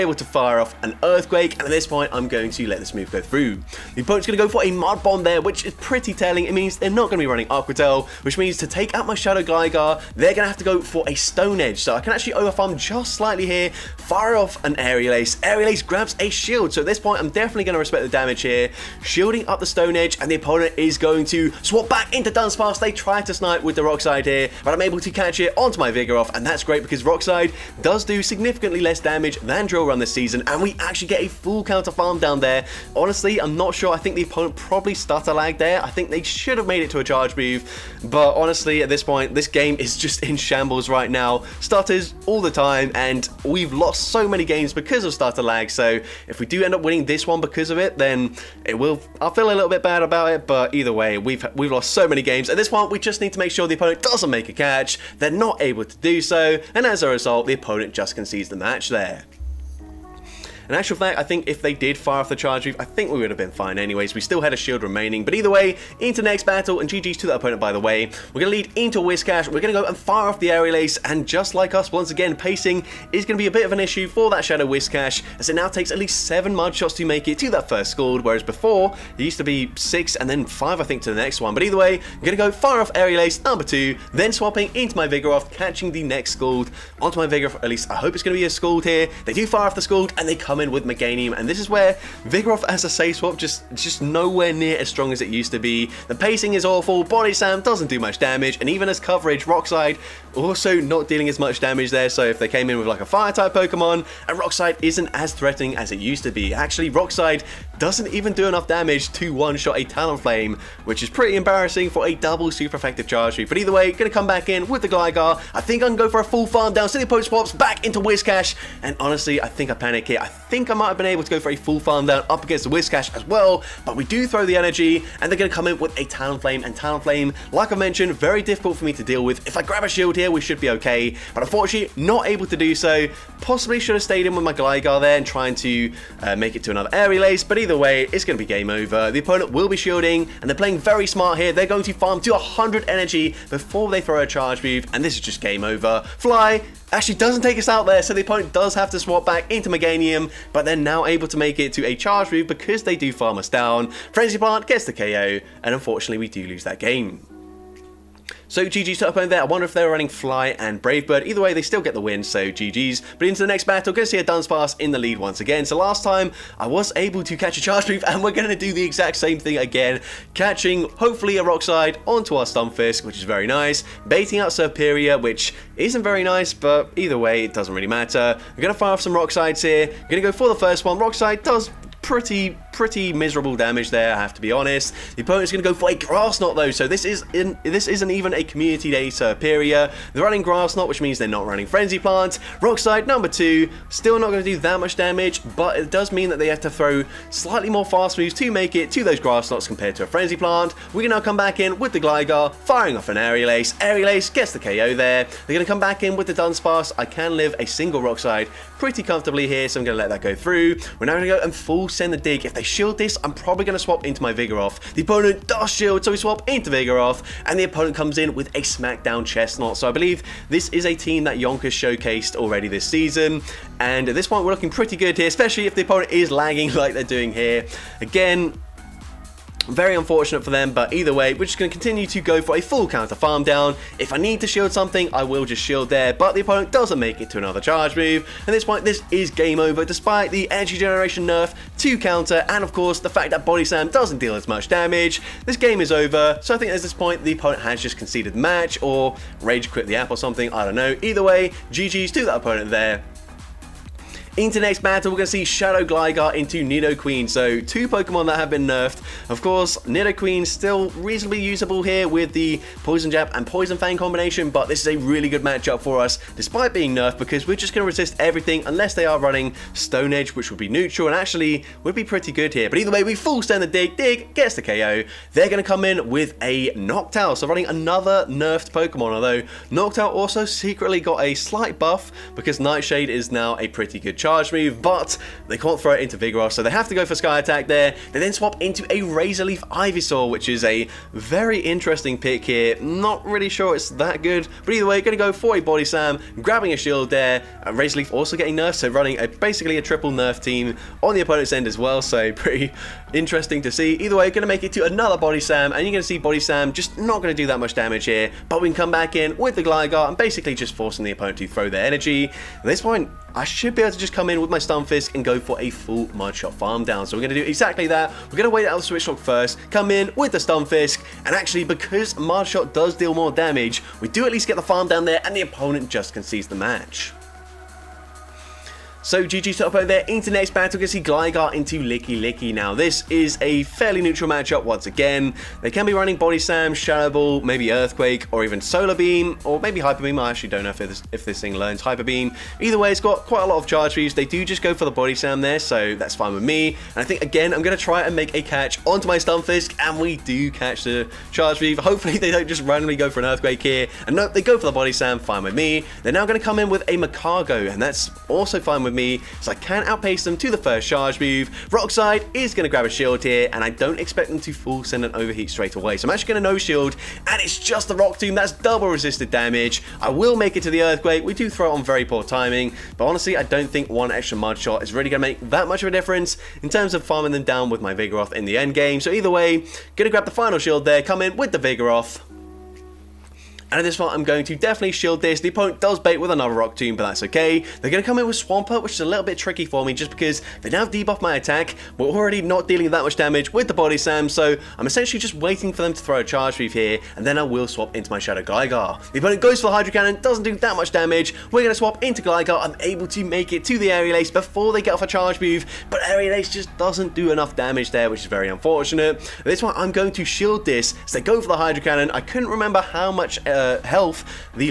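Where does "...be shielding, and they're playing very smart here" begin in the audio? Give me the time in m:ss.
2:19.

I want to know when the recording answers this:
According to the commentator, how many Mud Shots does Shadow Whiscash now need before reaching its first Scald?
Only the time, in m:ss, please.
1:16.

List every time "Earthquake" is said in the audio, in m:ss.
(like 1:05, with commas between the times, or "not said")
0:01, 5:37, 5:53, 6:10.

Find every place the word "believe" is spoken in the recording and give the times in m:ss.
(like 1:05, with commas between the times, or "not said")
3:39.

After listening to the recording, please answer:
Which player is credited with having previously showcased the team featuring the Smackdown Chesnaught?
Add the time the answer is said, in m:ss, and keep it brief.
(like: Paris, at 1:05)
Yonkers, at 3:41.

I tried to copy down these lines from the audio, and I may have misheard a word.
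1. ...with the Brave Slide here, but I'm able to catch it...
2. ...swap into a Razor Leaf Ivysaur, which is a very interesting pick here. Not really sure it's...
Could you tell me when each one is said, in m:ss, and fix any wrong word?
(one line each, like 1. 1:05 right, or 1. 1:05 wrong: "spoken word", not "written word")
1. 0:23 wrong: "Rock", not "Brave"
2. 4:48 right.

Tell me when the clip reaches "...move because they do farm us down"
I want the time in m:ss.
2:32.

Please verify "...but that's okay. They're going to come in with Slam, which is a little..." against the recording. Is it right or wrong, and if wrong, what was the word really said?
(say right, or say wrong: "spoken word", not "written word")
wrong: "Swampert", not "Slam".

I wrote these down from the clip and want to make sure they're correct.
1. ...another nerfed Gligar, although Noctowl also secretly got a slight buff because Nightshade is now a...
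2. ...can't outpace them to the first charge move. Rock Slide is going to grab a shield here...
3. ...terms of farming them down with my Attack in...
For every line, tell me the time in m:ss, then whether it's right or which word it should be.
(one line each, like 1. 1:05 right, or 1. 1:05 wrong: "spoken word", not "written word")
1. 4:37 wrong: "Pokemon", not "Gligar"
2. 5:59 right
3. 6:16 wrong: "Vigoroth", not "Attack".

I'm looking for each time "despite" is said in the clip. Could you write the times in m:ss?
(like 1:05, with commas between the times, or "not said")
3:59, 4:26.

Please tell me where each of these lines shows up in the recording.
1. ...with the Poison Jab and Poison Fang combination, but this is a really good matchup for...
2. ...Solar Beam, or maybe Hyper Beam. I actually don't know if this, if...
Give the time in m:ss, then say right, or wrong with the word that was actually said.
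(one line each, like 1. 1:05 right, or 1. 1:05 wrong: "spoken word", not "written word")
1. 4:22 right
2. 5:38 right.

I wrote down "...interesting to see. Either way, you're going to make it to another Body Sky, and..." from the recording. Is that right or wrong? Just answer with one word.
wrong.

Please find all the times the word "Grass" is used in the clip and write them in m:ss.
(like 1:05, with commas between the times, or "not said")
3:05, 3:10, 3:19.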